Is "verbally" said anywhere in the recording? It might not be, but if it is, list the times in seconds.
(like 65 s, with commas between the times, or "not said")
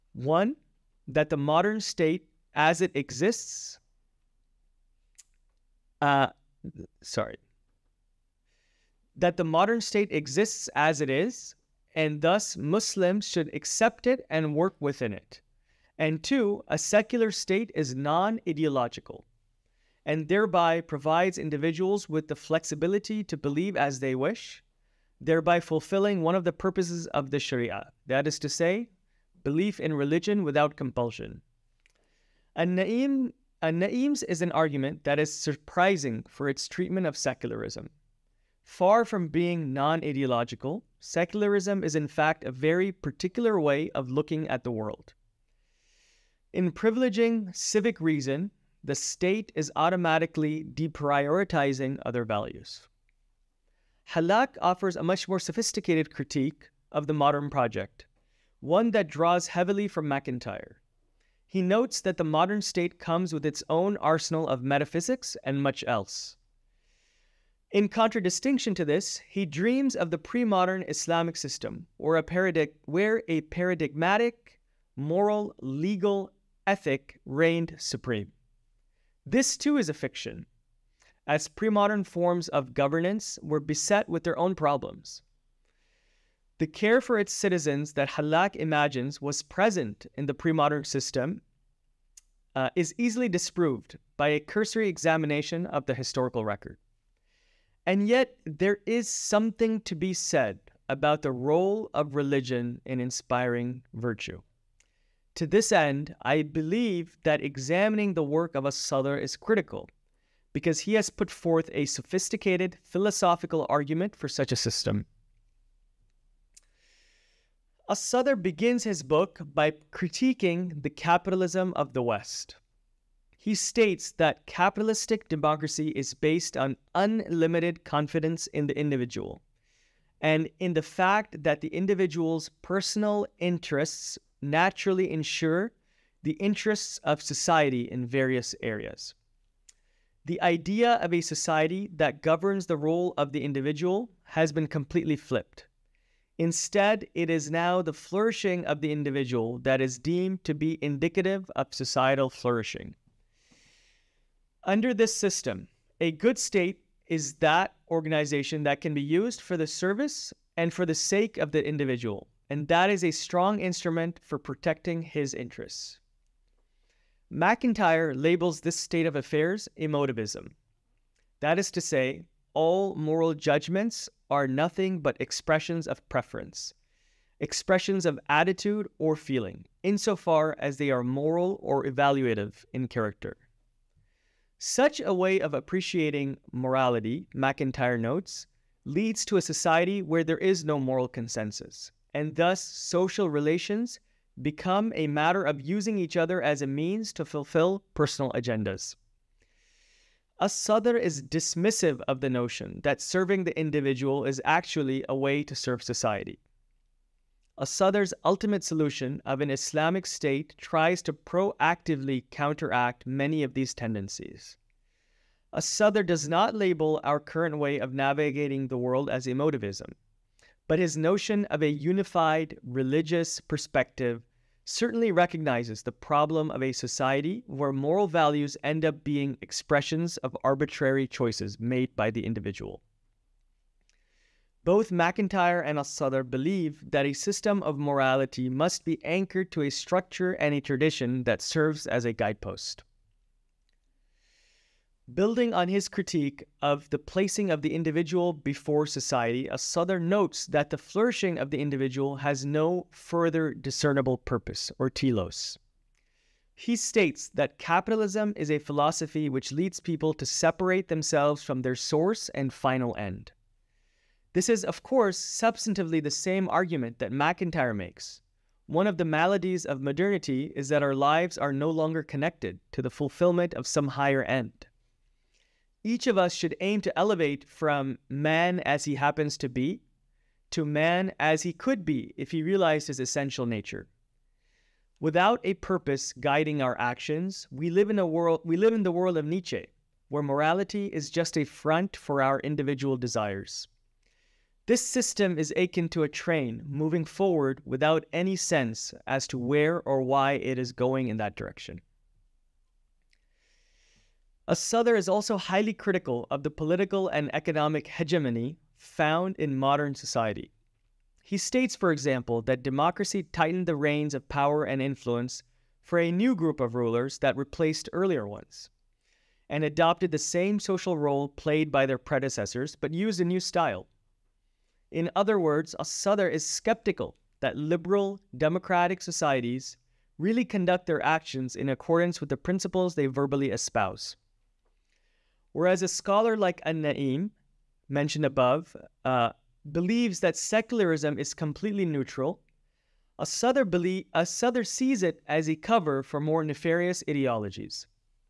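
333 s.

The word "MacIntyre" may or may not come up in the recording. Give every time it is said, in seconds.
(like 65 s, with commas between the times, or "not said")
60 s, 167 s, 187 s, 234 s, 267 s.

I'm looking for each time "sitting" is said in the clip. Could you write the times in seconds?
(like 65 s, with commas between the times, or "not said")
not said.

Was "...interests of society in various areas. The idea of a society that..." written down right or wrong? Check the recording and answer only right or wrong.
right.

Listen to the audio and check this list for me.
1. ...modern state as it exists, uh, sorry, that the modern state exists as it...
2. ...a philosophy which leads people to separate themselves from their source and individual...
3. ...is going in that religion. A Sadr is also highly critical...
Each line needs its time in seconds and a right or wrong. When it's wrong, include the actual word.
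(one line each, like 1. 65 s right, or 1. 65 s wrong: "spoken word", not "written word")
1. 1 s right
2. 258 s wrong: "final", not "individual"
3. 300 s wrong: "direction", not "religion".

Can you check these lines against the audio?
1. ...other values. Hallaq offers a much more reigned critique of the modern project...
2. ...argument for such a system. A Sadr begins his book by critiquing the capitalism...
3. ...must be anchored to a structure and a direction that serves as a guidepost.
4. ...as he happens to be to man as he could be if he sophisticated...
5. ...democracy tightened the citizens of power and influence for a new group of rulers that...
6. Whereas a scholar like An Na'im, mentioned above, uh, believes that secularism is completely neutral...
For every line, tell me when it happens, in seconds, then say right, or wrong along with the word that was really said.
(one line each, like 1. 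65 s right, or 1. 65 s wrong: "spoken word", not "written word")
1. 52 s wrong: "sophisticated", not "reigned"
2. 113 s right
3. 238 s wrong: "tradition", not "direction"
4. 278 s wrong: "realized", not "sophisticated"
5. 312 s wrong: "reins", not "citizens"
6. 335 s right.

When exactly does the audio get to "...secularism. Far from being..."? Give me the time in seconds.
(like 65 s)
37 s.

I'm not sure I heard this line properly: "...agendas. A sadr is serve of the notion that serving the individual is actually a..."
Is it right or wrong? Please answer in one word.
wrong.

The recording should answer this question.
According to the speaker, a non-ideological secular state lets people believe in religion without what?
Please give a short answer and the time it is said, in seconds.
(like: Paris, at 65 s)
compulsion, at 30 s.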